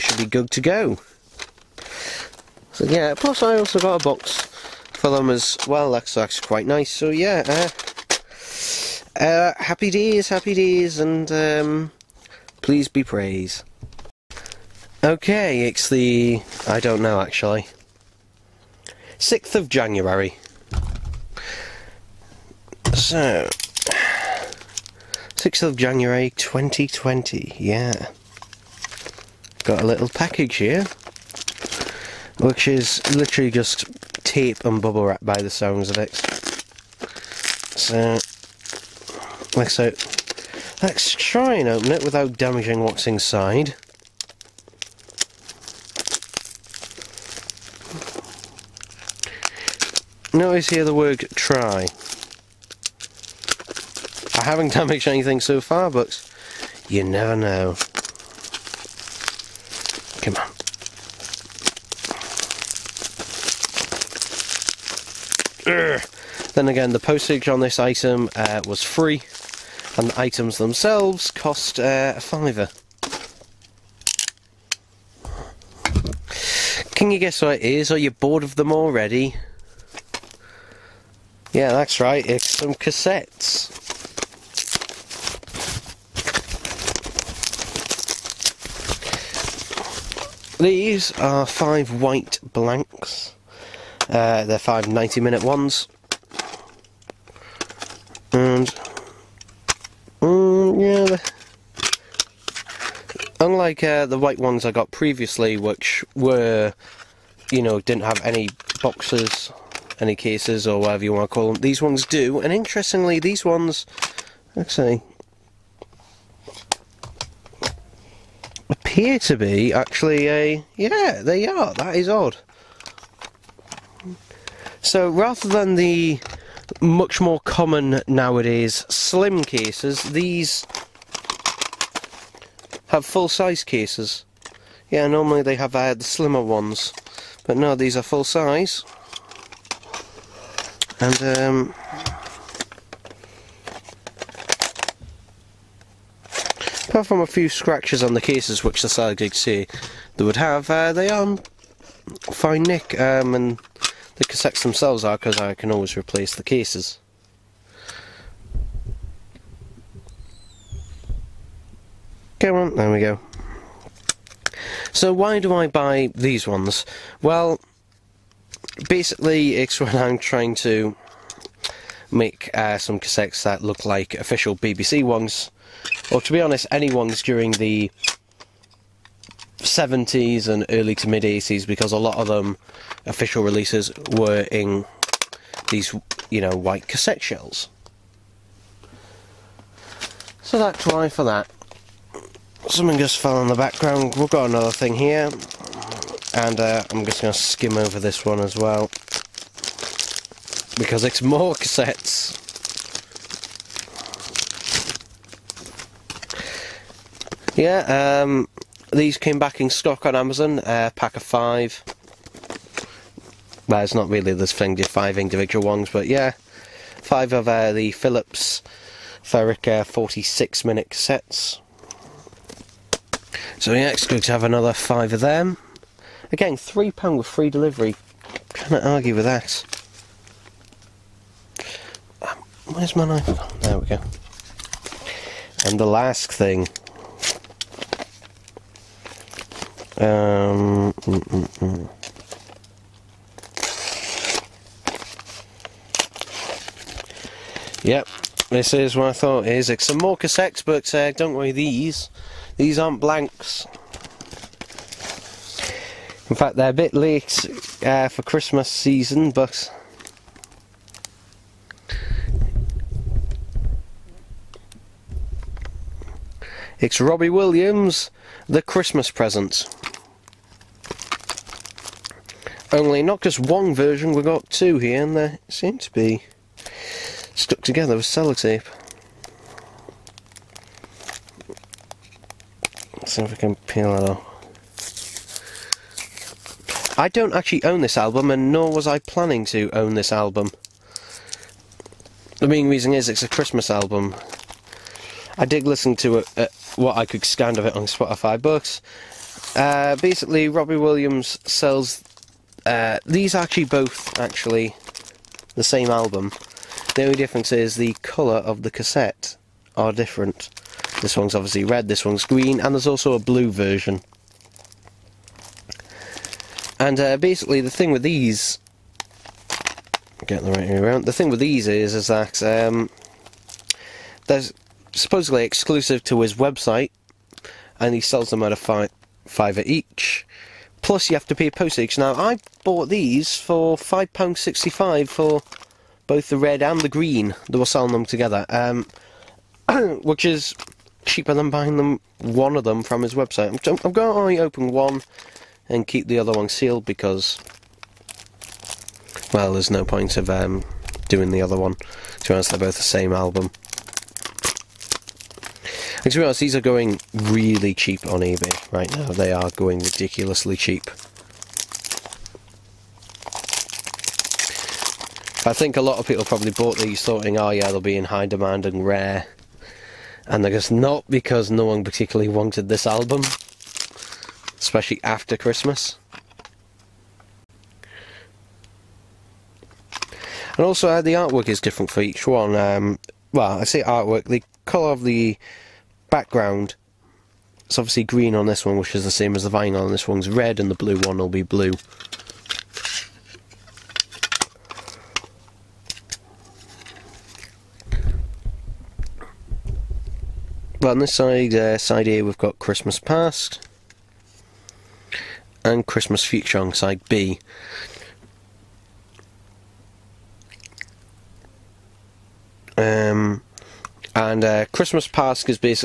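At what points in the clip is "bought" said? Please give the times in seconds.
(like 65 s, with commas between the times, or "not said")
332 s, 366 s.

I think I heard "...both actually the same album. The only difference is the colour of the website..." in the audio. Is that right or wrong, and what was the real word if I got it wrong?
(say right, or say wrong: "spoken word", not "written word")
wrong: "cassette", not "website".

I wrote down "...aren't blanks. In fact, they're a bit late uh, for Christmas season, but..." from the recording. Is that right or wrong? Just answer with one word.
right.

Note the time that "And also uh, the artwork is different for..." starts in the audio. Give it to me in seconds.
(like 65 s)
380 s.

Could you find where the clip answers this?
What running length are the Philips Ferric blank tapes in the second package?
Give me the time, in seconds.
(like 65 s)
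219 s.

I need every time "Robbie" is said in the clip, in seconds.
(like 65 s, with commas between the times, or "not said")
267 s, 300 s.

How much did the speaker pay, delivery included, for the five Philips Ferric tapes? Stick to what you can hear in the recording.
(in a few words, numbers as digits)
£3.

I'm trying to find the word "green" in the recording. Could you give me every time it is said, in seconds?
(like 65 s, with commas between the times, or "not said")
312 s, 336 s, 388 s.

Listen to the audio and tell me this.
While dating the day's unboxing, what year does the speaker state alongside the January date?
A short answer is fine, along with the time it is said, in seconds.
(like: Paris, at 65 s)
2020, at 26 s.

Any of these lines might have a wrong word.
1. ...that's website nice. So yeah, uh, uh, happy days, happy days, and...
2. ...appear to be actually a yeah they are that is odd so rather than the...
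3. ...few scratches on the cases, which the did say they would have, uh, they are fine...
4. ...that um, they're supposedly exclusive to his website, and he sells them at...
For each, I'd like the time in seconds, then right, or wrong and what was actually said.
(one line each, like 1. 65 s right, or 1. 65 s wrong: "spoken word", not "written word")
1. 6 s wrong: "quite", not "website"
2. 118 s right
3. 147 s right
4. 322 s right.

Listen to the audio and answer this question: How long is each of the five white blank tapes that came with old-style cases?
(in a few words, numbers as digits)
90 minutes.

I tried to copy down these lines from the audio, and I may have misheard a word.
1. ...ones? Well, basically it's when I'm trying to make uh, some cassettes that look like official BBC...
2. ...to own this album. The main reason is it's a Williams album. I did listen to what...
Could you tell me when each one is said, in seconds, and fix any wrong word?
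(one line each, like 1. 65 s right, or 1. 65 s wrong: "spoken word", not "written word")
1. 166 s right
2. 289 s wrong: "Christmas", not "Williams".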